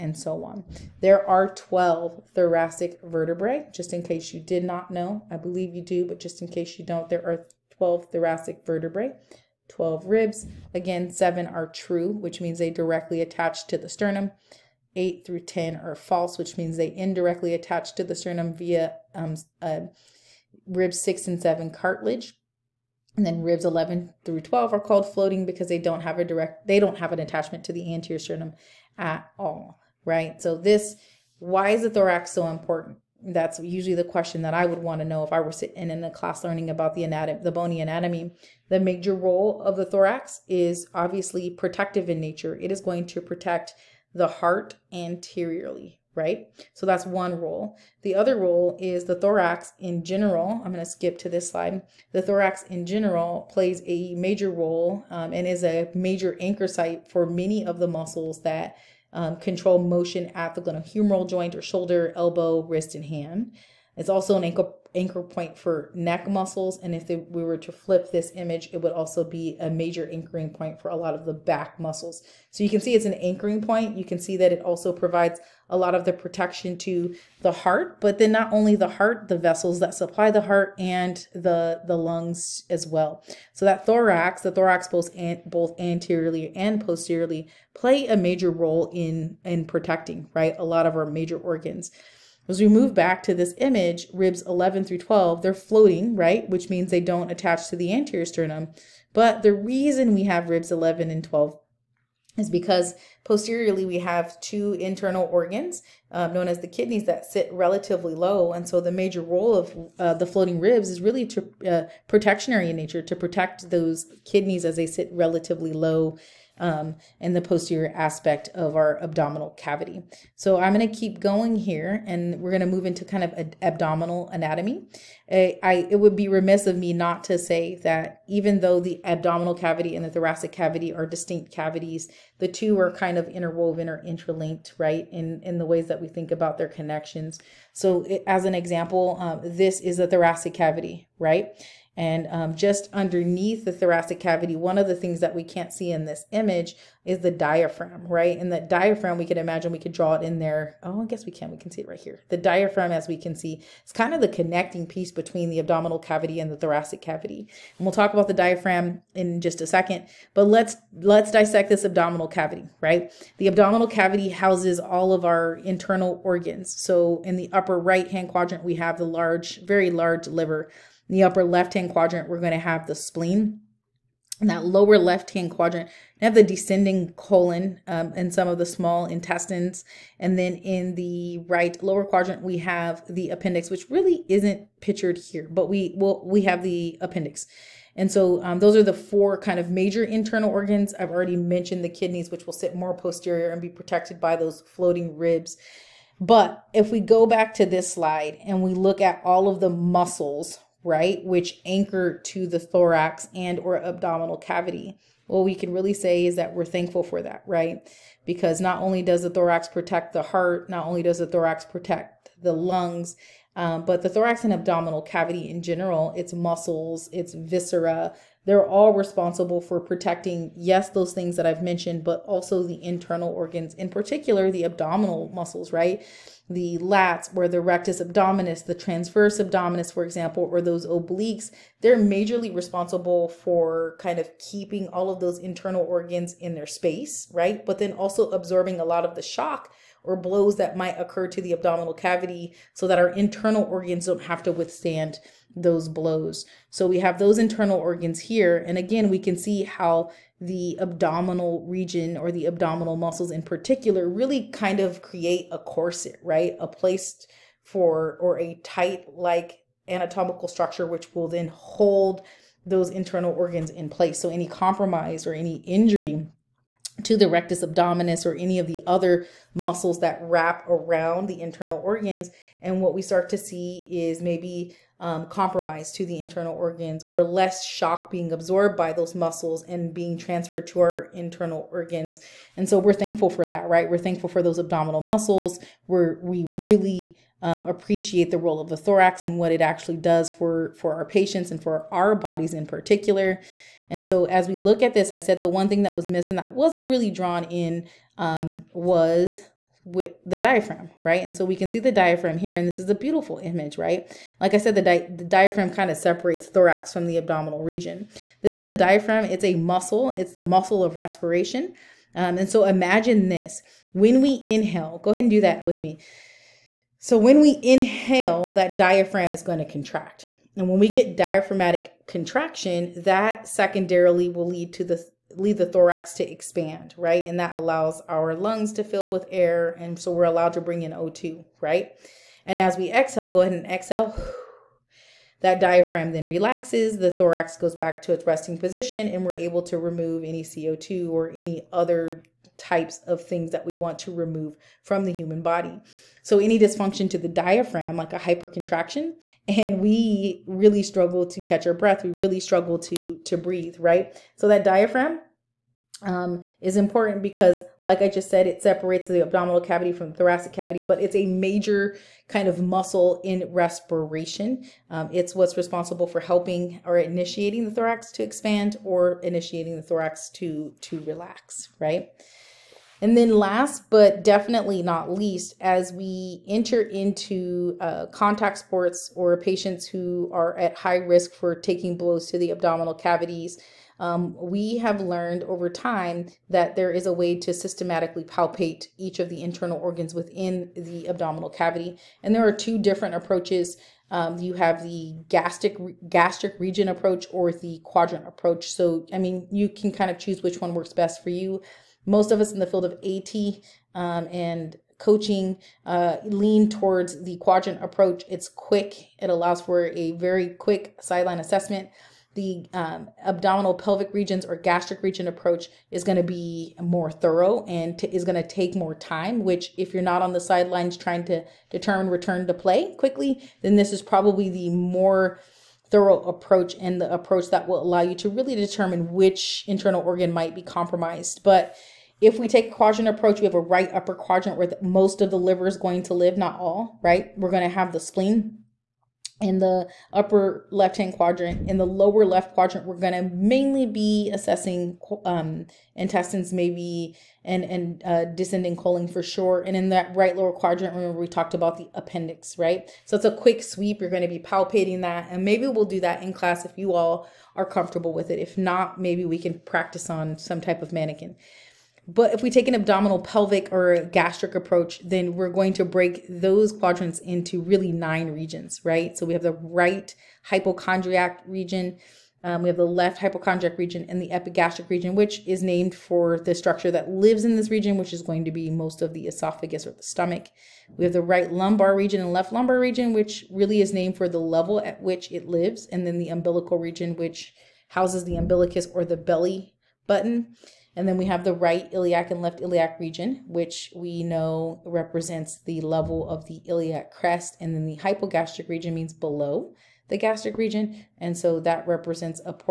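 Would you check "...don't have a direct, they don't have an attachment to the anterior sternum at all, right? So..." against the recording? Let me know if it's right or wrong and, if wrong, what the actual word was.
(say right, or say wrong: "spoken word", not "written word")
right.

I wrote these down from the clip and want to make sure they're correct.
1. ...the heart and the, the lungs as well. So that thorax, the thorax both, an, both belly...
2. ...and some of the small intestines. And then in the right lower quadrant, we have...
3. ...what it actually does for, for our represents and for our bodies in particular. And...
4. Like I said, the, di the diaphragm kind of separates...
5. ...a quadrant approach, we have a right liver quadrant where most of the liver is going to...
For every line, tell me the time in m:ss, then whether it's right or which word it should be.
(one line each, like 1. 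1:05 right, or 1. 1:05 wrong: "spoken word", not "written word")
1. 1:20 wrong: "anteriorly", not "belly"
2. 2:58 right
3. 4:49 wrong: "patients", not "represents"
4. 5:04 right
5. 7:12 wrong: "upper", not "liver".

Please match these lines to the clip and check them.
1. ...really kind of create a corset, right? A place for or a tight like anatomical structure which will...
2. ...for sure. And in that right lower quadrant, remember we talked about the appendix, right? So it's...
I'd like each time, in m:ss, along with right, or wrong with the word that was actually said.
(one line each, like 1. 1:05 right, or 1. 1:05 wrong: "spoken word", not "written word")
1. 4:14 right
2. 7:29 right.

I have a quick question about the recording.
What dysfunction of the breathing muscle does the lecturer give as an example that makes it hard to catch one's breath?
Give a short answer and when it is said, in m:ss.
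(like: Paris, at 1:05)
hypercontraction, at 5:48.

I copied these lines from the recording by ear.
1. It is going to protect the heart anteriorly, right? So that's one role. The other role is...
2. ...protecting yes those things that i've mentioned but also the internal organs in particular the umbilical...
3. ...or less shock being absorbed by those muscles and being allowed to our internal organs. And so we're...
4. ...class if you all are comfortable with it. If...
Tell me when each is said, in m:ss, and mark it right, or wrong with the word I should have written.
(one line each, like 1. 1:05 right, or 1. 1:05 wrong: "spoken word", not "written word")
1. 0:42 right
2. 3:39 wrong: "abdominal", not "umbilical"
3. 4:37 wrong: "transferred", not "allowed"
4. 7:36 right.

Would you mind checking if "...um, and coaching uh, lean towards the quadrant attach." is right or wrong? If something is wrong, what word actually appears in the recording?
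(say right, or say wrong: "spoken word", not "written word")
wrong: "approach", not "attach".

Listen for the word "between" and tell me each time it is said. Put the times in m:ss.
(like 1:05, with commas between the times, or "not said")
2:35.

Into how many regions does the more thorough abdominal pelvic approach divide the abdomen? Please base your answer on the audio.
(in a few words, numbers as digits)
9.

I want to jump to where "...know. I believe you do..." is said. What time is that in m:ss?
0:04.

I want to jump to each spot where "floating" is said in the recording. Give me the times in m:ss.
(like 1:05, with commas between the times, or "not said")
0:25, 1:35, 1:50, 3:14.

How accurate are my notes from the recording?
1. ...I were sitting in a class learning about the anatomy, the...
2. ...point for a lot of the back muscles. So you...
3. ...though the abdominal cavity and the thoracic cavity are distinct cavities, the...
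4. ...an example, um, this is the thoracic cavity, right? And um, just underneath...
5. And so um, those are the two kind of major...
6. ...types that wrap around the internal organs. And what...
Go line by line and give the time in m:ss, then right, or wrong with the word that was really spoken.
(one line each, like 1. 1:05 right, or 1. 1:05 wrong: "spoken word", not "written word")
1. 0:35 right
2. 1:10 right
3. 2:08 right
4. 2:18 right
5. 3:07 wrong: "four", not "two"
6. 4:29 wrong: "muscles", not "types".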